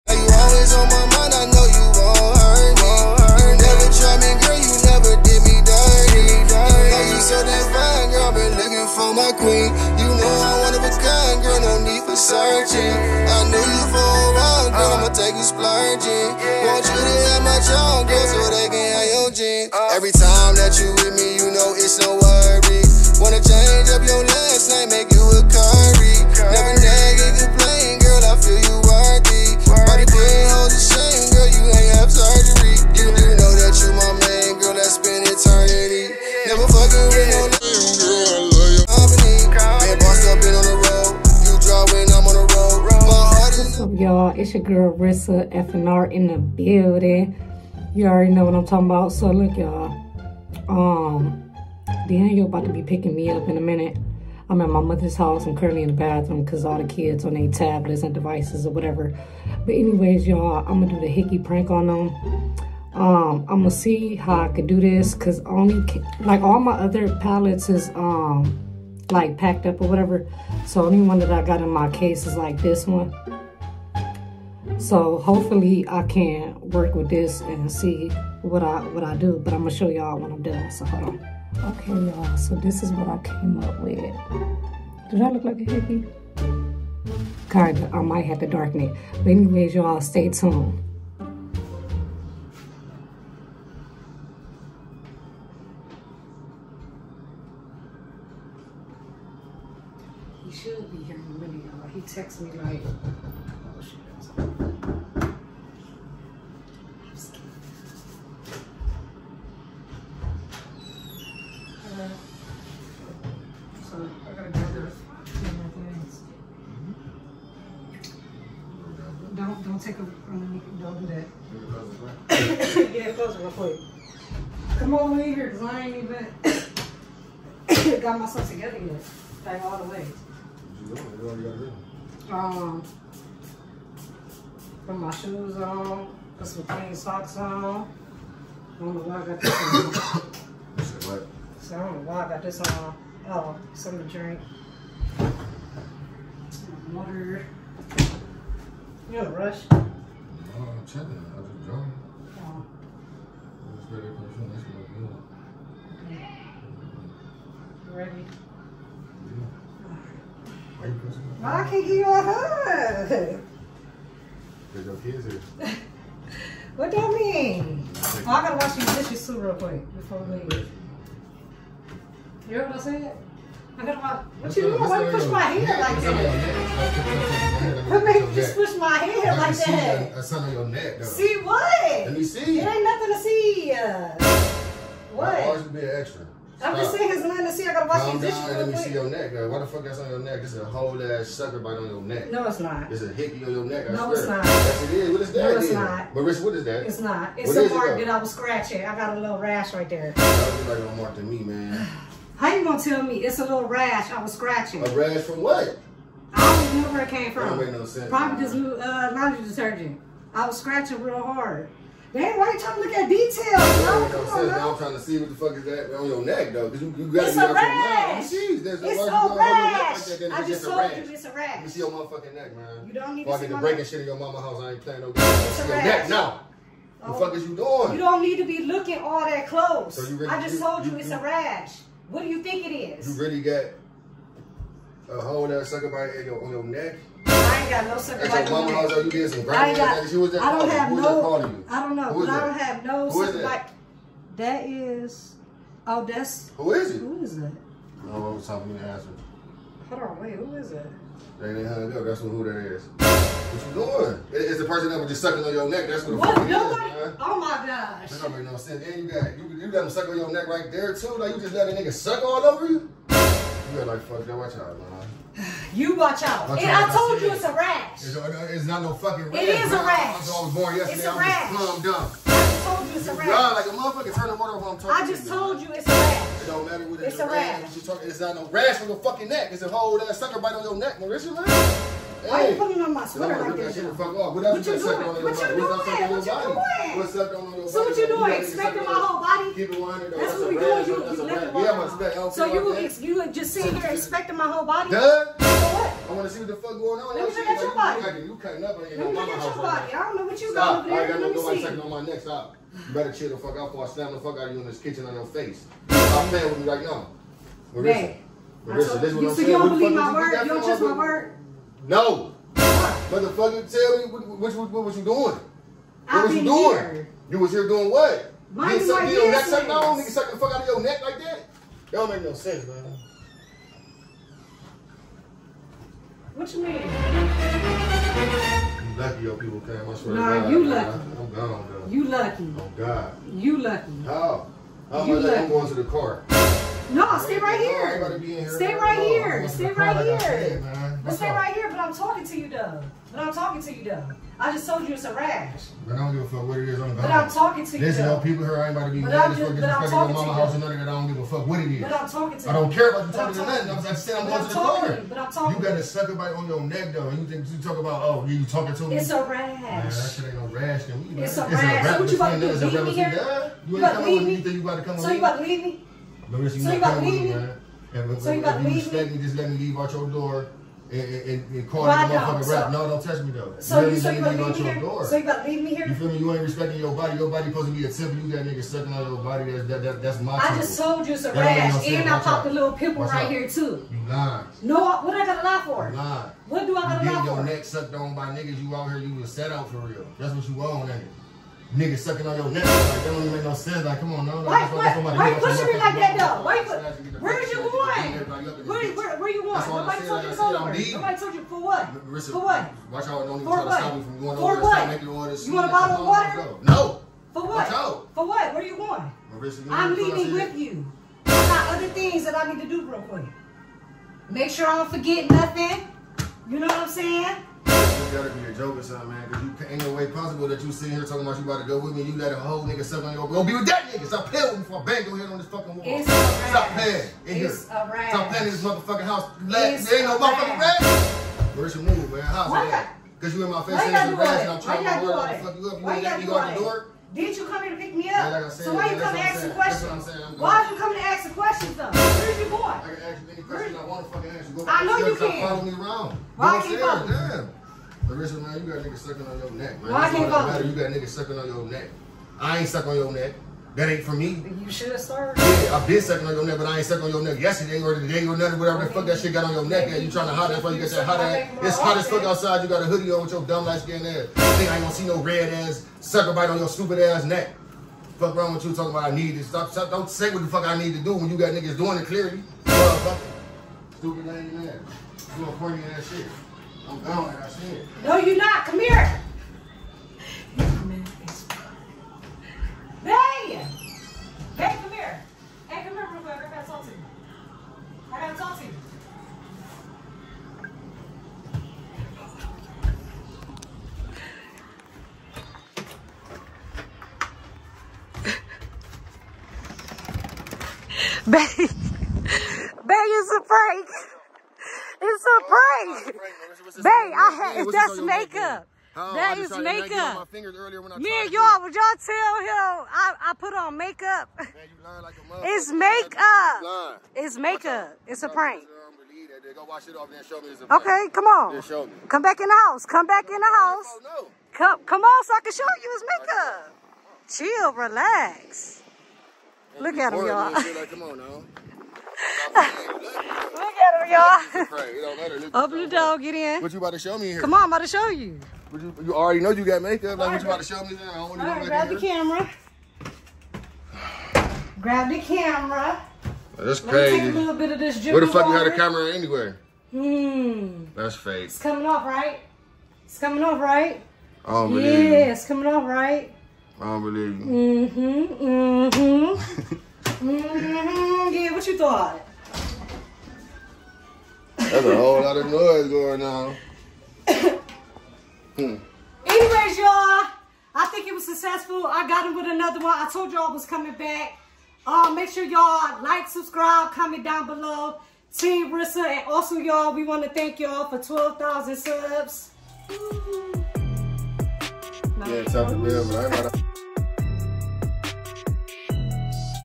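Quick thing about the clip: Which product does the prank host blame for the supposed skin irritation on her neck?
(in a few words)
laundry detergent.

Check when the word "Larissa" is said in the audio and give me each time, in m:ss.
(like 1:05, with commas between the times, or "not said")
7:28.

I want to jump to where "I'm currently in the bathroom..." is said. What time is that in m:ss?
0:55.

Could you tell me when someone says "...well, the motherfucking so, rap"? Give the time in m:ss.
6:11.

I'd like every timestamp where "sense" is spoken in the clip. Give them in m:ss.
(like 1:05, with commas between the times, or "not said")
3:27, 4:18, 5:22, 6:33.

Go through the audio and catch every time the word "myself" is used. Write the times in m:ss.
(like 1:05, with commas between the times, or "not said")
2:08.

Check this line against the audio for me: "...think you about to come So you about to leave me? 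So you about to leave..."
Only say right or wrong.
right.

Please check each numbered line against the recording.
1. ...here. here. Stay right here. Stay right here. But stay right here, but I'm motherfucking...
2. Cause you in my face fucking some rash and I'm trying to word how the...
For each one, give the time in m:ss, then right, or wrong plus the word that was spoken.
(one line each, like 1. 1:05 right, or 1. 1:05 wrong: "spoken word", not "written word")
1. 5:37 wrong: "talking", not "motherfucking"
2. 7:13 wrong: "saying", not "fucking".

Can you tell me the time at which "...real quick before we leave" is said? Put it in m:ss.
2:49.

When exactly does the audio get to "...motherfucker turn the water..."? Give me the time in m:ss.
4:33.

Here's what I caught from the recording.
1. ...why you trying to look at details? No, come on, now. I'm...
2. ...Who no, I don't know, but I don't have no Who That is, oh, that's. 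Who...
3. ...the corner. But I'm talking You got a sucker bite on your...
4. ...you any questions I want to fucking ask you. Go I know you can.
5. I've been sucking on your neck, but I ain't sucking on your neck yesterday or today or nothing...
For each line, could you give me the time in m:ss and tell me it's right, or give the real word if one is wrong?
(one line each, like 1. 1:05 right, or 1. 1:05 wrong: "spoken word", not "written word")
1. 3:32 right
2. 4:00 right
3. 5:54 right
4. 7:23 right
5. 7:35 right.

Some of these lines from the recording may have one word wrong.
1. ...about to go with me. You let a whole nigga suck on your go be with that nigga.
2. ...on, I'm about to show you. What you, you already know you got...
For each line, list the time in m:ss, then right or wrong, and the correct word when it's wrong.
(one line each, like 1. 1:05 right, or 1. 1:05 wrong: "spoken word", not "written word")
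1. 7:01 right
2. 8:57 right.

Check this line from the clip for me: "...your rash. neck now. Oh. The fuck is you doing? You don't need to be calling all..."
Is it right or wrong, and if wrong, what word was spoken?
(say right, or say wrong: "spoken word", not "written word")
wrong: "looking", not "calling".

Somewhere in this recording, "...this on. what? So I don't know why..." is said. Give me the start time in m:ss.
2:19.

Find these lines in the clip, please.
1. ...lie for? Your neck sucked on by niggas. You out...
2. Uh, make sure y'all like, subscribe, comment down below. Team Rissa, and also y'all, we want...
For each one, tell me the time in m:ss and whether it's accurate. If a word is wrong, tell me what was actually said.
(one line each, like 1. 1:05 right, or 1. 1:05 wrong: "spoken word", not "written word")
1. 6:27 right
2. 9:34 right.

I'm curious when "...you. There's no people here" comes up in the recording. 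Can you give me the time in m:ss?
5:47.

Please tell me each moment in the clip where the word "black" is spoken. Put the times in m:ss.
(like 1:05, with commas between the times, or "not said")
not said.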